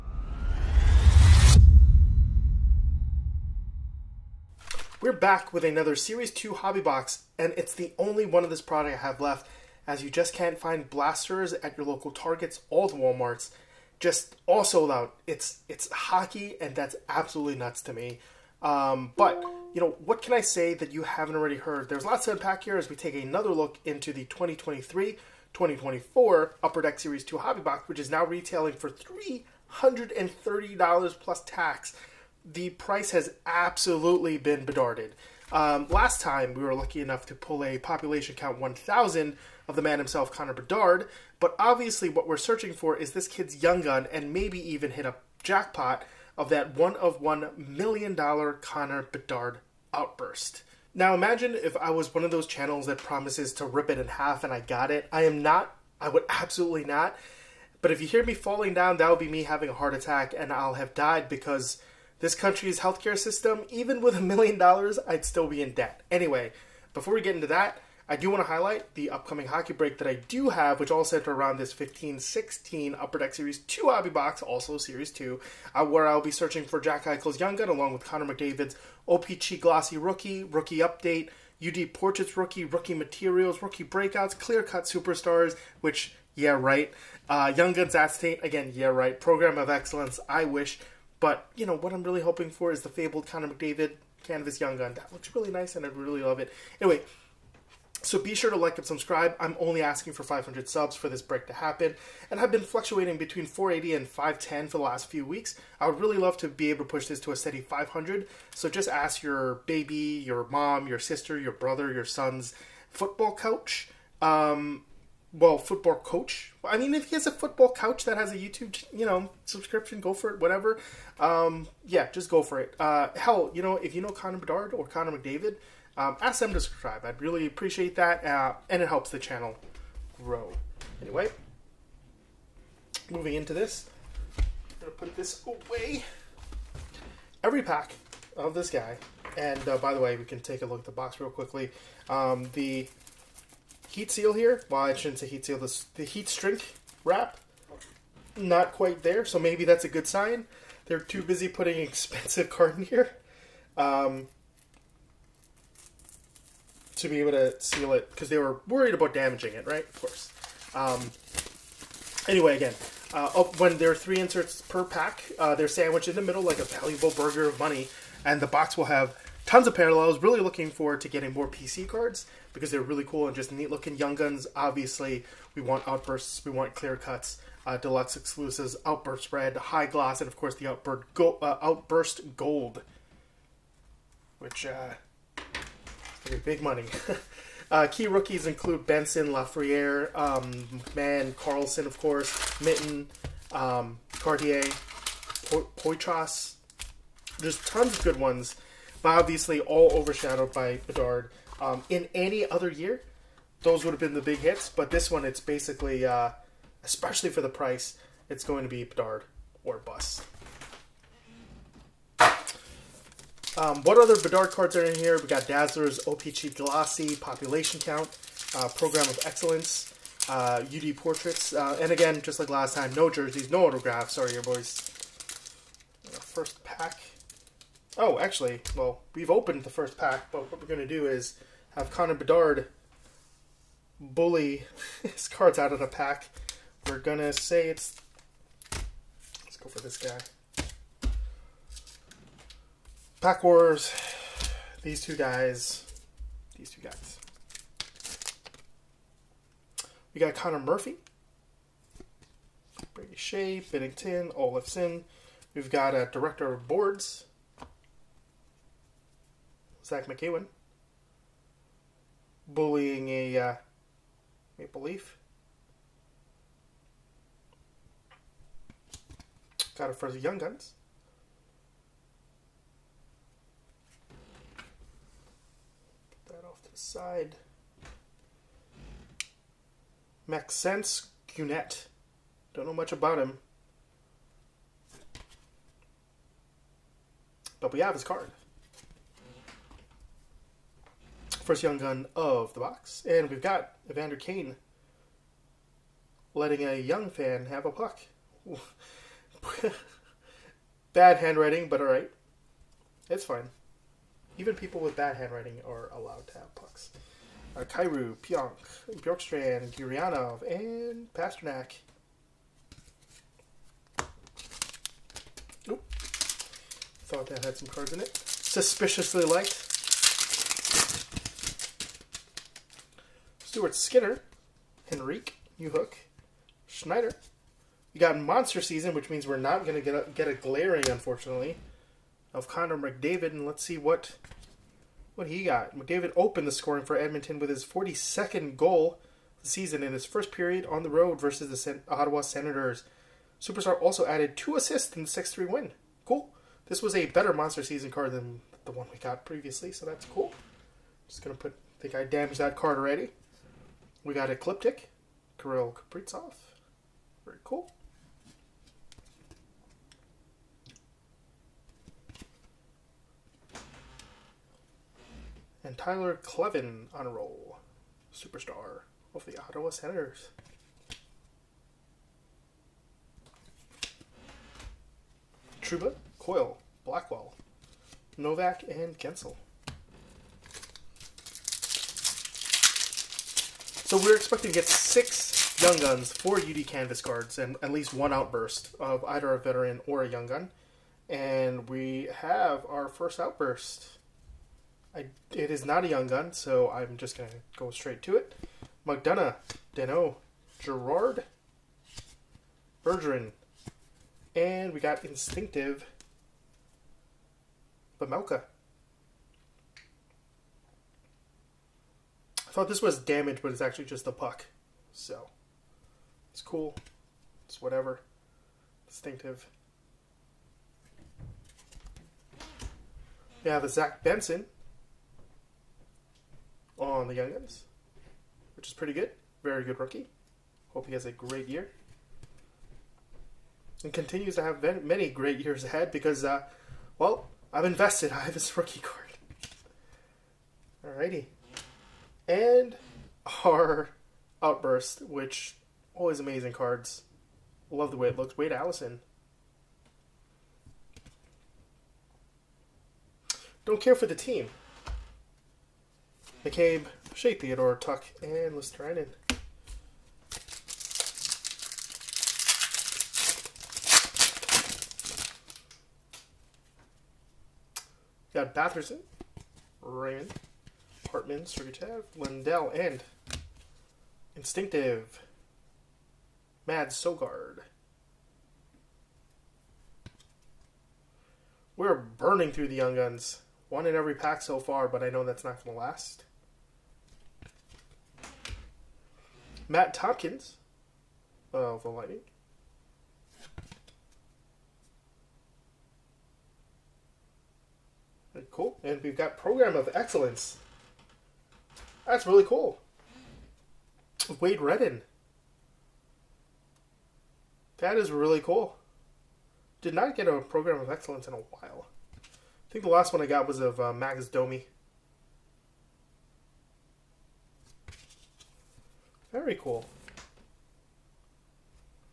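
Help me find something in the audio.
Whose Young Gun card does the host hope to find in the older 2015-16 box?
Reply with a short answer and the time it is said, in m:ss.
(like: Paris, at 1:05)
Jack Eichel, at 1:16.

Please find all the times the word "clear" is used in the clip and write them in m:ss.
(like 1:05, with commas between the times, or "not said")
1:24, 2:56.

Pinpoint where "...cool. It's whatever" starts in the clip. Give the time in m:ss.
6:56.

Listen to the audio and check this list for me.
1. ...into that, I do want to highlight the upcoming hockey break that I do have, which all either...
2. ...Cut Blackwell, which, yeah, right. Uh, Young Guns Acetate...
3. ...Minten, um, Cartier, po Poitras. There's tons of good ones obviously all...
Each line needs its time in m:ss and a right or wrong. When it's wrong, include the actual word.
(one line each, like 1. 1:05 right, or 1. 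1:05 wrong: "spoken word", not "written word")
1. 1:07 wrong: "center", not "either"
2. 1:24 wrong: "Superstars", not "Blackwell"
3. 3:12 right.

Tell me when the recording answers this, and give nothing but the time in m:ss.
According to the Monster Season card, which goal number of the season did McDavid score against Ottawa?
5:37.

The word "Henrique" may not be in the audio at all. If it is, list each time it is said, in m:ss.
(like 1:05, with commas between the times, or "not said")
5:24.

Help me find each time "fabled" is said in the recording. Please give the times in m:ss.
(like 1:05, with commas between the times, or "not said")
1:32.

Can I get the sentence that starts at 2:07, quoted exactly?
I'd really appreciate that, uh, and it helps the channel grow.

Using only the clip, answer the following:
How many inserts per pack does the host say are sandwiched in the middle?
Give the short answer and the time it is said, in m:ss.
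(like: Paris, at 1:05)
3, at 2:43.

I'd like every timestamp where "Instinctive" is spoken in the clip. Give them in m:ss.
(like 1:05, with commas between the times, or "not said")
6:45, 7:54.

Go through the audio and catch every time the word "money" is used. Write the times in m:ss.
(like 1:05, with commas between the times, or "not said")
2:47, 3:06.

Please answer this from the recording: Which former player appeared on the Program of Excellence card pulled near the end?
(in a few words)
Wade Redden.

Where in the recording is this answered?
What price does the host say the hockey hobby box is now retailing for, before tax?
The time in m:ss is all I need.
0:28.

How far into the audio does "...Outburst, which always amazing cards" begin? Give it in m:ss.
7:24.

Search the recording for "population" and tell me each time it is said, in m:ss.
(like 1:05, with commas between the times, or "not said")
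0:37, 3:37.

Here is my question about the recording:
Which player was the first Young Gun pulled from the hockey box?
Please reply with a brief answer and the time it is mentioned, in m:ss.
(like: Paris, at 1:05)
Maxence Guenette, at 4:40.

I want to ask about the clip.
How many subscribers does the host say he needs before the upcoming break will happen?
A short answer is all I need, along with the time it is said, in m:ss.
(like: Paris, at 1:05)
500, at 1:40.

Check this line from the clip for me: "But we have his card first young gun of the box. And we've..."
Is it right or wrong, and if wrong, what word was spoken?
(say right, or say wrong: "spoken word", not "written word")
right.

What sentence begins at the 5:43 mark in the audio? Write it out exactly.
Superstar also added two assists in the 6-3 win.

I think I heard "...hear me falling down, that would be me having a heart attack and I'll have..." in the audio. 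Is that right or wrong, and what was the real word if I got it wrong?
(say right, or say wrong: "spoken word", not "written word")
right.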